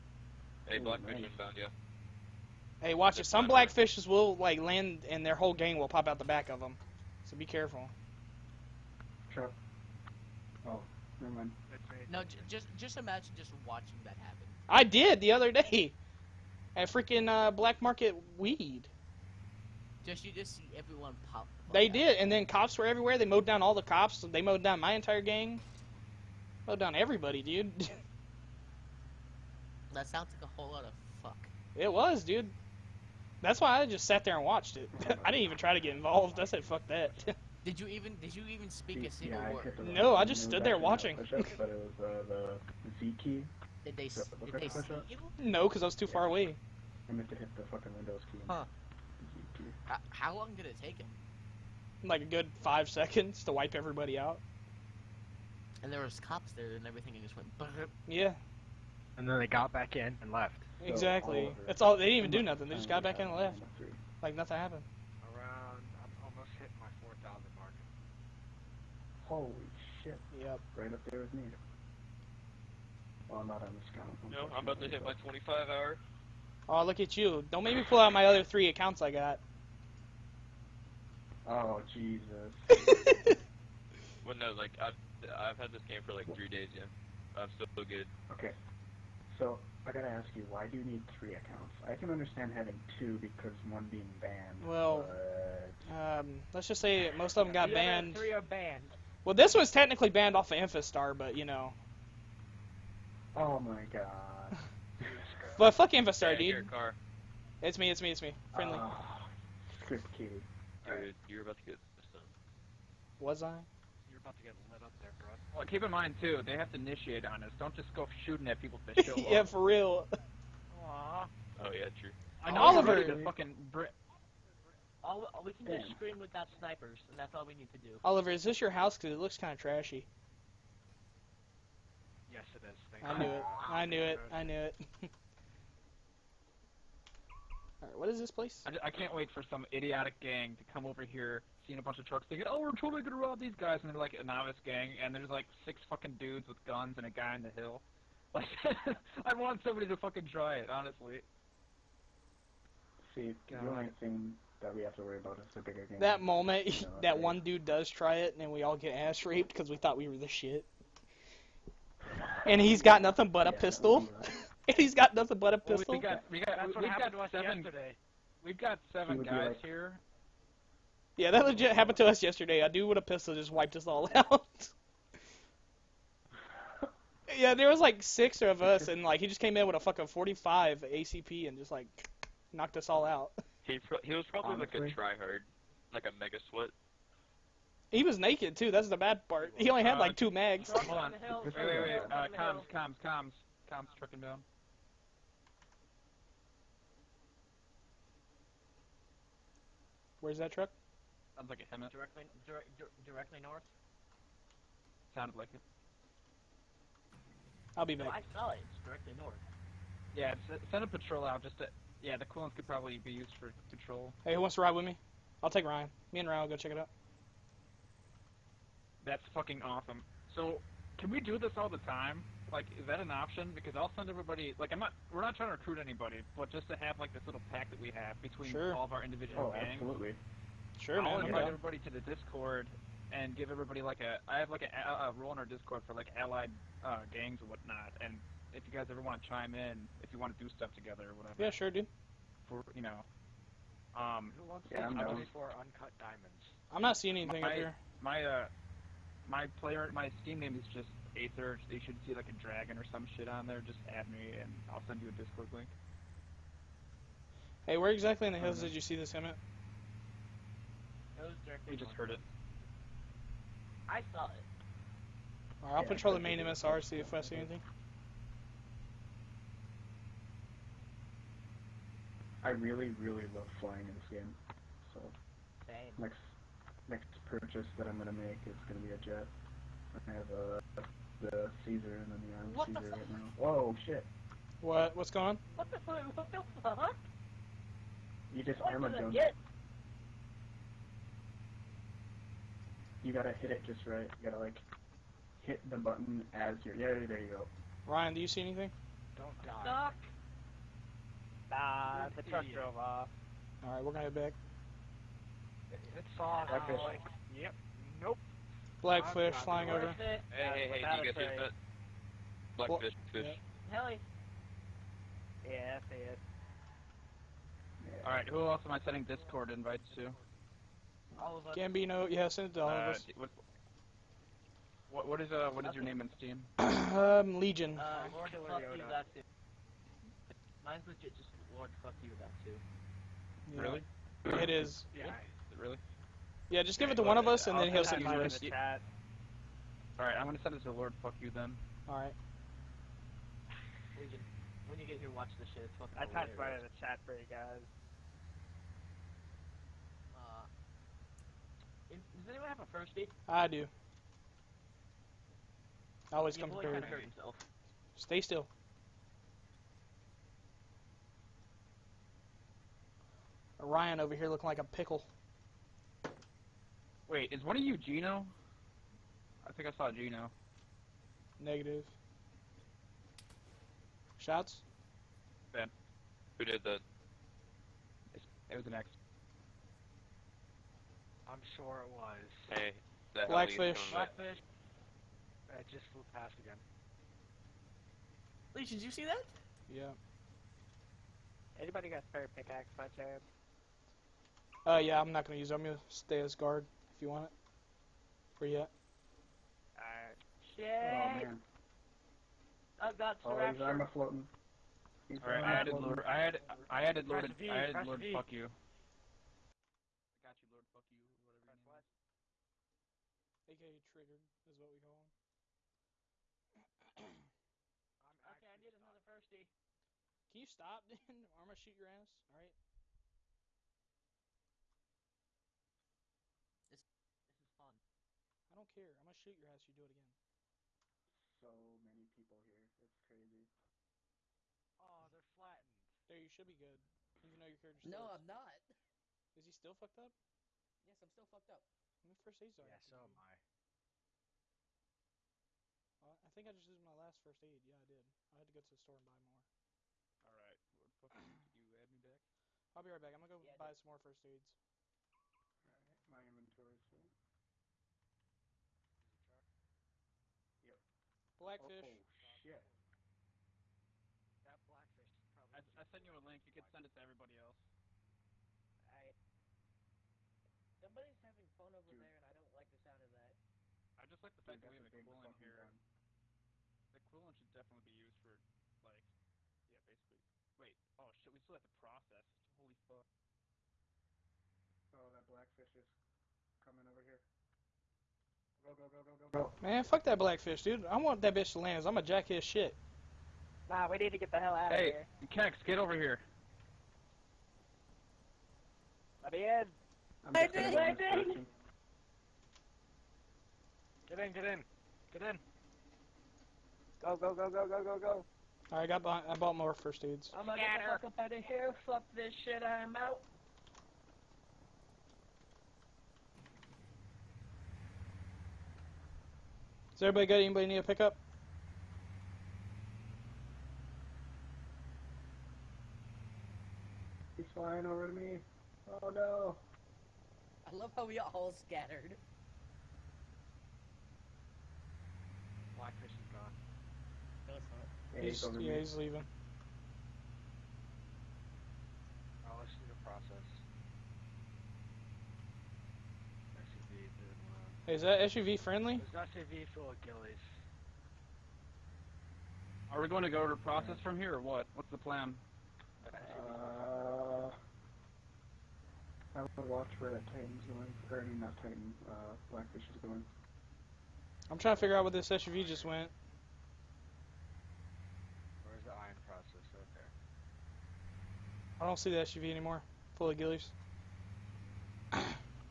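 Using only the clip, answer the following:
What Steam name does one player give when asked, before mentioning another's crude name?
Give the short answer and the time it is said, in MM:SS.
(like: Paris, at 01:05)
Legion, at 05:27.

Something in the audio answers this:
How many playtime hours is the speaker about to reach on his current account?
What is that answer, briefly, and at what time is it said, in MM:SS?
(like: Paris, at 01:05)
25, at 01:15.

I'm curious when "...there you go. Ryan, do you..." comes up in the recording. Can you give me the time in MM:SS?
04:57.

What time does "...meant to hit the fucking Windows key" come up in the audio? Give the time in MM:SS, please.
00:47.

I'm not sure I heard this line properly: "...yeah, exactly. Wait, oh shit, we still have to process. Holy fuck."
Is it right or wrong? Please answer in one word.
wrong.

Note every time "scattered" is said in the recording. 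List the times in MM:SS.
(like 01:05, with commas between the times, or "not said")
08:51.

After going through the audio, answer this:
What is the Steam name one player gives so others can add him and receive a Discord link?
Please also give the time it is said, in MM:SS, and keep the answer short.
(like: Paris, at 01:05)
Aether, at 04:11.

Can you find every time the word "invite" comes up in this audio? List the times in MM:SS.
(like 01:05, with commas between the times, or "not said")
03:51, 05:19.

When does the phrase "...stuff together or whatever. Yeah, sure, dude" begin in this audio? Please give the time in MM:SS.
04:00.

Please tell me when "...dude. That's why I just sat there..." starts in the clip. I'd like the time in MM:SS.
00:32.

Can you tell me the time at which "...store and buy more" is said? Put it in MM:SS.
07:28.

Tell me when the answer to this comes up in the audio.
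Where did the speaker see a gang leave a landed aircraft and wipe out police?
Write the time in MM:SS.
00:17.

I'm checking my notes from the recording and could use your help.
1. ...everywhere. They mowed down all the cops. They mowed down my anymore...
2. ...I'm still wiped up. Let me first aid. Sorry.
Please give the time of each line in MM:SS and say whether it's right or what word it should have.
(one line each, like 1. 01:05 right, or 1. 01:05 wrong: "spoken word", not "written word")
1. 00:22 wrong: "entire", not "anymore"
2. 07:21 wrong: "fucked", not "wiped".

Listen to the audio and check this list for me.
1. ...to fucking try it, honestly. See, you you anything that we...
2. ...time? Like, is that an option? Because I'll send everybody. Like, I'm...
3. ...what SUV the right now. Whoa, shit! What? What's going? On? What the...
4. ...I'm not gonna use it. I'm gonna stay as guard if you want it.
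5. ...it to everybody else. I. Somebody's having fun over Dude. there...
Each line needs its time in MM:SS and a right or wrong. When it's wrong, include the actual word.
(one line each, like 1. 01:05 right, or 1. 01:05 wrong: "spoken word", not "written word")
1. 02:29 right
2. 03:41 right
3. 04:42 wrong: "Caesar", not "SUV"
4. 06:35 right
5. 07:46 right.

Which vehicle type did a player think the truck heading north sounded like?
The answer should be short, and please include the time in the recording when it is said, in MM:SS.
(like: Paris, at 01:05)
HEMTT, at 03:21.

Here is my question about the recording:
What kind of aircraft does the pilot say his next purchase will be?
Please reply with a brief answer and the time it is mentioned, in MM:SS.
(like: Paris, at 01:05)
A jet, at 04:38.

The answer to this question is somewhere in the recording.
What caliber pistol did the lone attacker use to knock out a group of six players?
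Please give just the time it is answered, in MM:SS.
03:00.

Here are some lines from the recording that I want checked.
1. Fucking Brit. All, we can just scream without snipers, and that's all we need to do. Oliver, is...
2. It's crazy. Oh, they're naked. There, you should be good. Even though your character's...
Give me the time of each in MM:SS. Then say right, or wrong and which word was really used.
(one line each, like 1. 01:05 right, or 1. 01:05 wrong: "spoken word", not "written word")
1. 02:03 right
2. 07:12 wrong: "flattened", not "naked".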